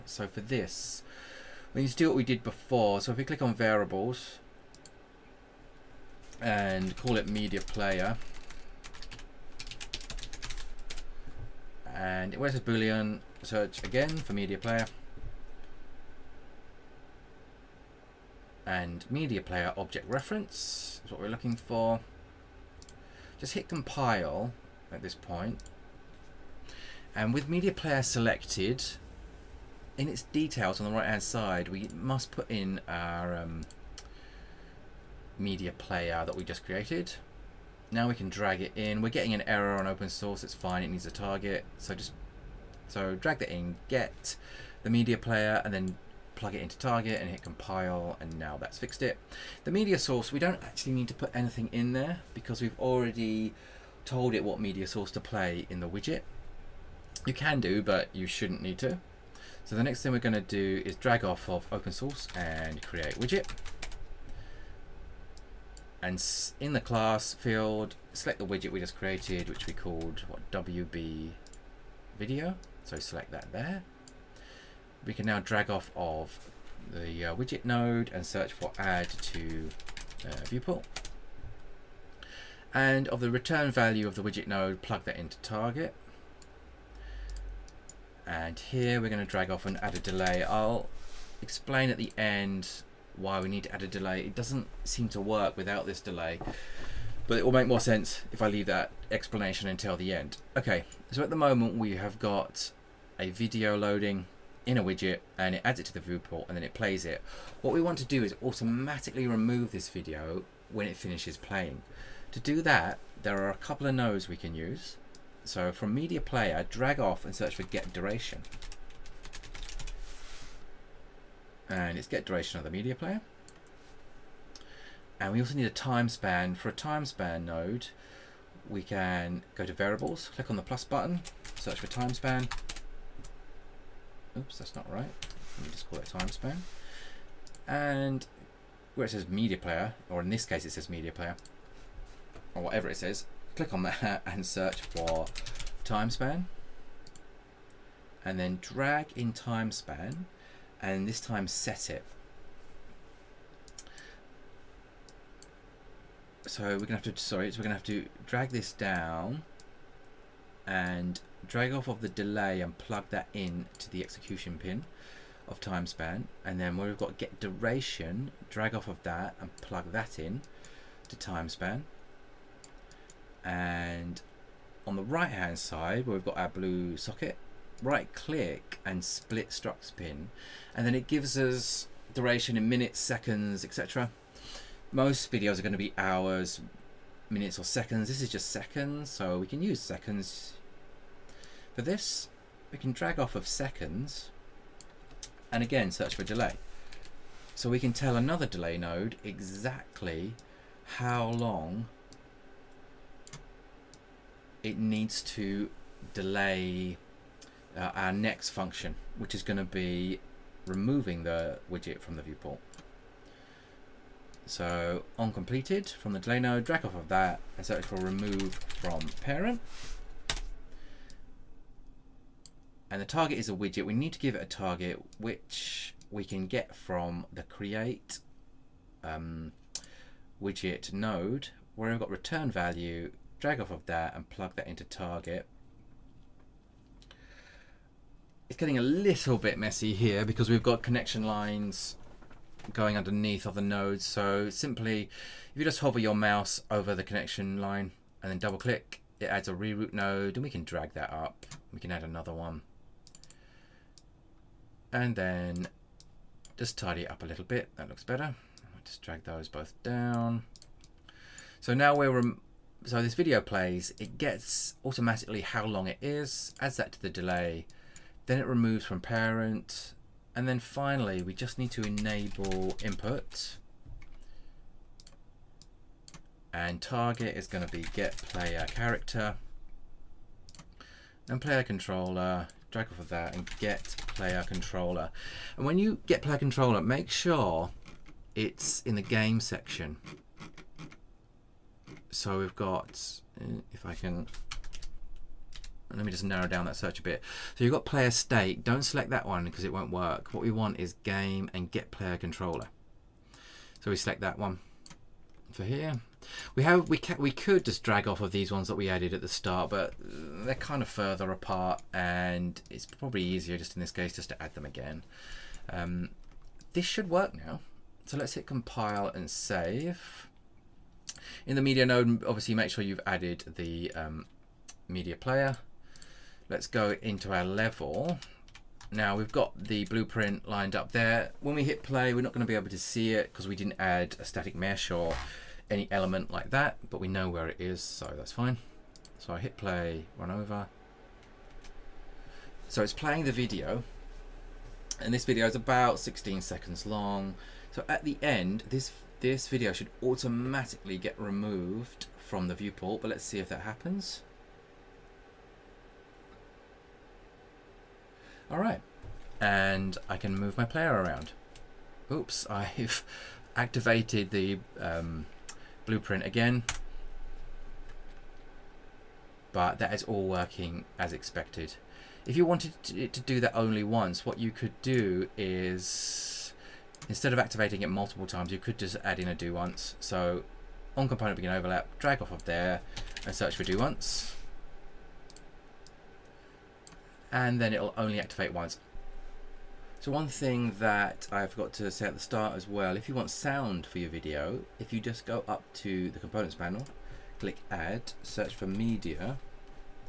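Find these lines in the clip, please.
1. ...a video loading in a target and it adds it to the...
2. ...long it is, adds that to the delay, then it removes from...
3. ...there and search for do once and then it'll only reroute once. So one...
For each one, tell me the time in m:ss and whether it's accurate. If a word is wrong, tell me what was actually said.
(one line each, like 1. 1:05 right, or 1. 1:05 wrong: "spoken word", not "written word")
1. 1:43 wrong: "widget", not "target"
2. 4:25 right
3. 6:22 wrong: "activate", not "reroute".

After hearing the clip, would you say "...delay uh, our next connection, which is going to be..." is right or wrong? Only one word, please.
wrong.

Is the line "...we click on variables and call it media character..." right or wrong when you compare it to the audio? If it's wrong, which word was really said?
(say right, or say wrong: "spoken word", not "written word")
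wrong: "player", not "character".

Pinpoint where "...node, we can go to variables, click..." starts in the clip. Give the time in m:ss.
2:07.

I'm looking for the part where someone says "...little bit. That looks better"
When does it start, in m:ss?
4:17.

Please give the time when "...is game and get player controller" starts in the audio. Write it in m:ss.
5:00.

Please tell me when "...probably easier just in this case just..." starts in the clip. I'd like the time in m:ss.
5:12.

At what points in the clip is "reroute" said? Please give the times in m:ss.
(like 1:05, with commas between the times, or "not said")
4:09.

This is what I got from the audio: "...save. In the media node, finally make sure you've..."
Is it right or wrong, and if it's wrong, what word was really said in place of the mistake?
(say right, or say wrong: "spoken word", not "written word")
wrong: "obviously", not "finally".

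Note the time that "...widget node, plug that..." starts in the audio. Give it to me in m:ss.
1:24.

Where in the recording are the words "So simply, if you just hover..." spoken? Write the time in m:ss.
4:04.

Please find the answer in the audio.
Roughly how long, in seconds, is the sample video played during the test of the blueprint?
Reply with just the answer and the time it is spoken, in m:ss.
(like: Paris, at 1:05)
16, at 5:45.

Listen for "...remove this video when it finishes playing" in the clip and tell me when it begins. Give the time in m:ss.
1:49.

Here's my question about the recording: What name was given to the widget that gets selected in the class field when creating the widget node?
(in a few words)
WB video.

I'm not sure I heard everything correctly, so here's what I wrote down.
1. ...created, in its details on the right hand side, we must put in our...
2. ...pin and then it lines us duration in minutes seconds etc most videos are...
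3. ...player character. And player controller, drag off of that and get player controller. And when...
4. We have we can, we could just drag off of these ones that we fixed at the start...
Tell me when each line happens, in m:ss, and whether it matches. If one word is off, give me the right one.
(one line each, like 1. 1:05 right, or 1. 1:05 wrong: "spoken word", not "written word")
1. 0:28 wrong: "selected", not "created"
2. 2:59 wrong: "gives", not "lines"
3. 4:38 right
4. 5:06 wrong: "added", not "fixed".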